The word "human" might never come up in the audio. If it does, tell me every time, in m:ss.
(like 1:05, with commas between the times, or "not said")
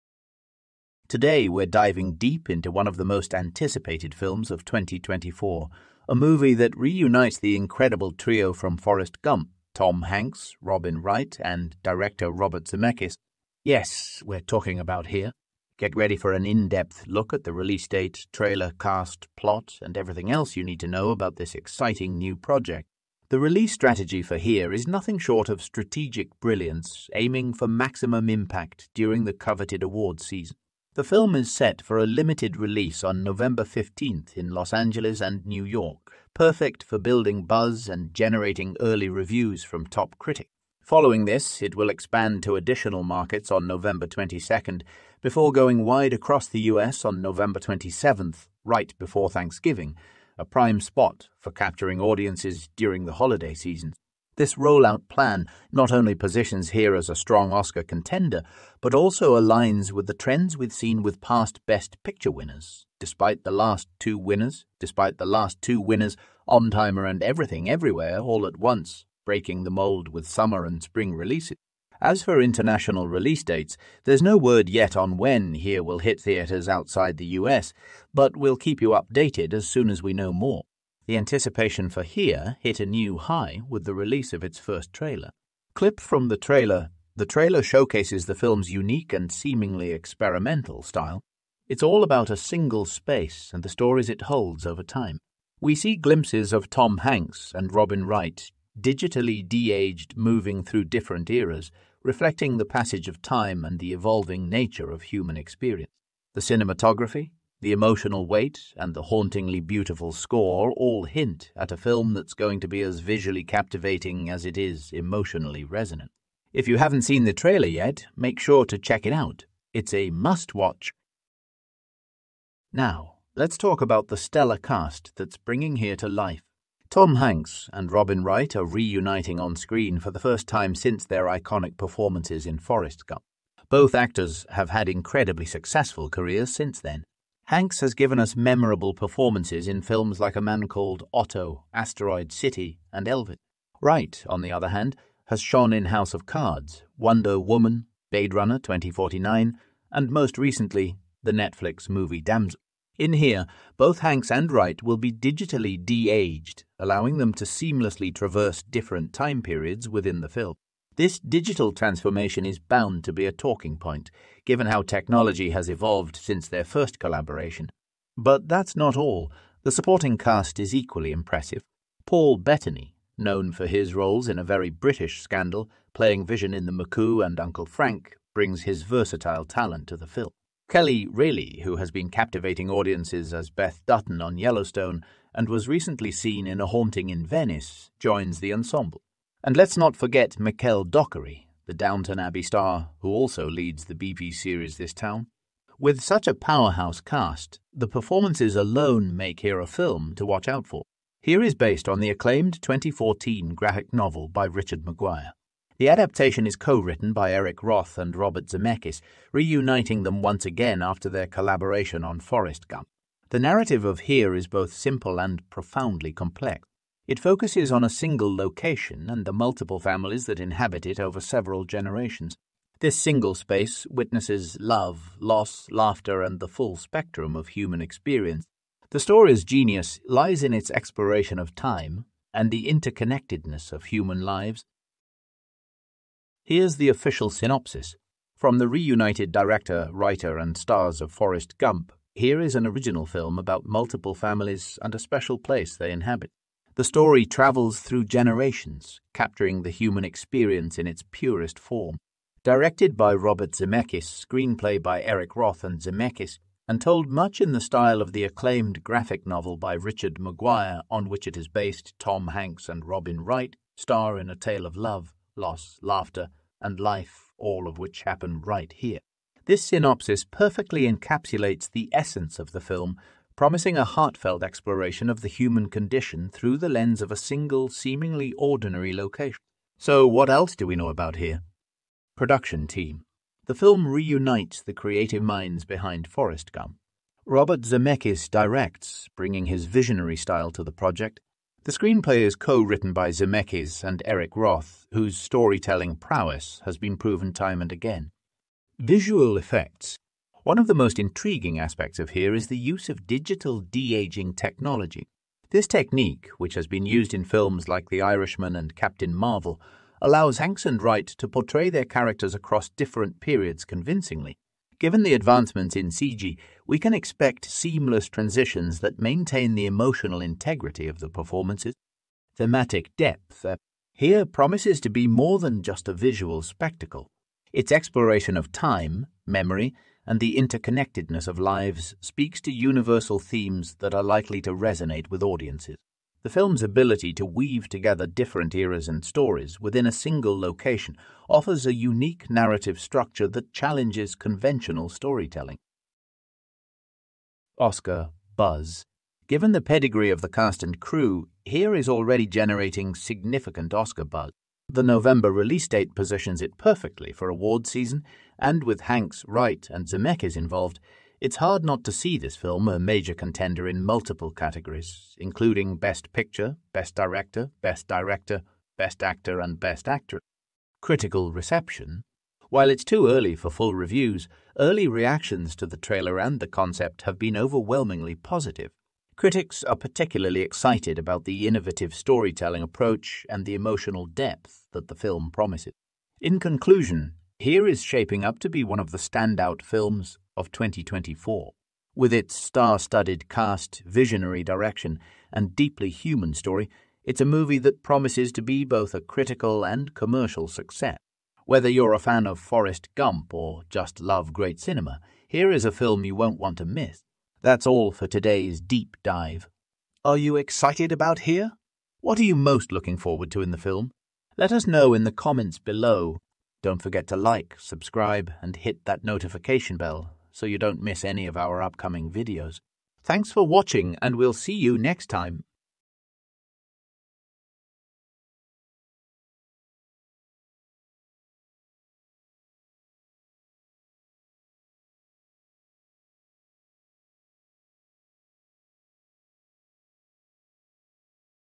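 1:45, 3:47, 3:53, 4:09, 4:35, 6:35.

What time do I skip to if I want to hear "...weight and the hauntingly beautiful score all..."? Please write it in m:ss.
1:48.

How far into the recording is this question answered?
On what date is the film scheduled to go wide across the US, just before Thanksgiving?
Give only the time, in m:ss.
0:47.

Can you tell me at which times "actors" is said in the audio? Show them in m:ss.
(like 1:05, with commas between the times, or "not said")
2:13, 6:09.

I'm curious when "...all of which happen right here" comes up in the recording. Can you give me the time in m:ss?
4:27.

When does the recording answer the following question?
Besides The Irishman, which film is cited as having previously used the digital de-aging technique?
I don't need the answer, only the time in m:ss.
5:08.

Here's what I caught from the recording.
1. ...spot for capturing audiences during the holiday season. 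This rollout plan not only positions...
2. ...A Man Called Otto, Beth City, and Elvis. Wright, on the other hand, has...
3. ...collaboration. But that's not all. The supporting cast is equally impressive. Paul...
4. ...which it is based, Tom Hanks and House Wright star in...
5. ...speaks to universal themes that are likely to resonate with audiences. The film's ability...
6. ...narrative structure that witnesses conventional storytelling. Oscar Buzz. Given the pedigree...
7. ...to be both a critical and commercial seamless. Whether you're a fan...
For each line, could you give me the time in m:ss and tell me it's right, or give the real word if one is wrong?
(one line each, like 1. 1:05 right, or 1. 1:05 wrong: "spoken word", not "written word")
1. 0:50 right
2. 2:20 wrong: "Asteroid", not "Beth"
3. 2:46 right
4. 4:21 wrong: "Robin", not "House"
5. 5:32 right
6. 5:42 wrong: "challenges", not "witnesses"
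7. 6:38 wrong: "success", not "seamless".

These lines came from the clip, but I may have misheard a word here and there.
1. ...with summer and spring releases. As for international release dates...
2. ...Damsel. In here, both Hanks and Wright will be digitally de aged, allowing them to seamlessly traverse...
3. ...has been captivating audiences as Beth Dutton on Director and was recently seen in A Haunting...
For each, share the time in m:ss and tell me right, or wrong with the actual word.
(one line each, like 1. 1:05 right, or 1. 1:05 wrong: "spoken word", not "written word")
1. 1:10 right
2. 2:32 right
3. 3:01 wrong: "Yellowstone", not "Director".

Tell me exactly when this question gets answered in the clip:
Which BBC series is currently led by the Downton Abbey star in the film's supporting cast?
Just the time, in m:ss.
3:14.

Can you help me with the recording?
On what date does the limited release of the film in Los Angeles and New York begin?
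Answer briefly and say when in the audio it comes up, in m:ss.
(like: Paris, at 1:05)
November 15, at 0:33.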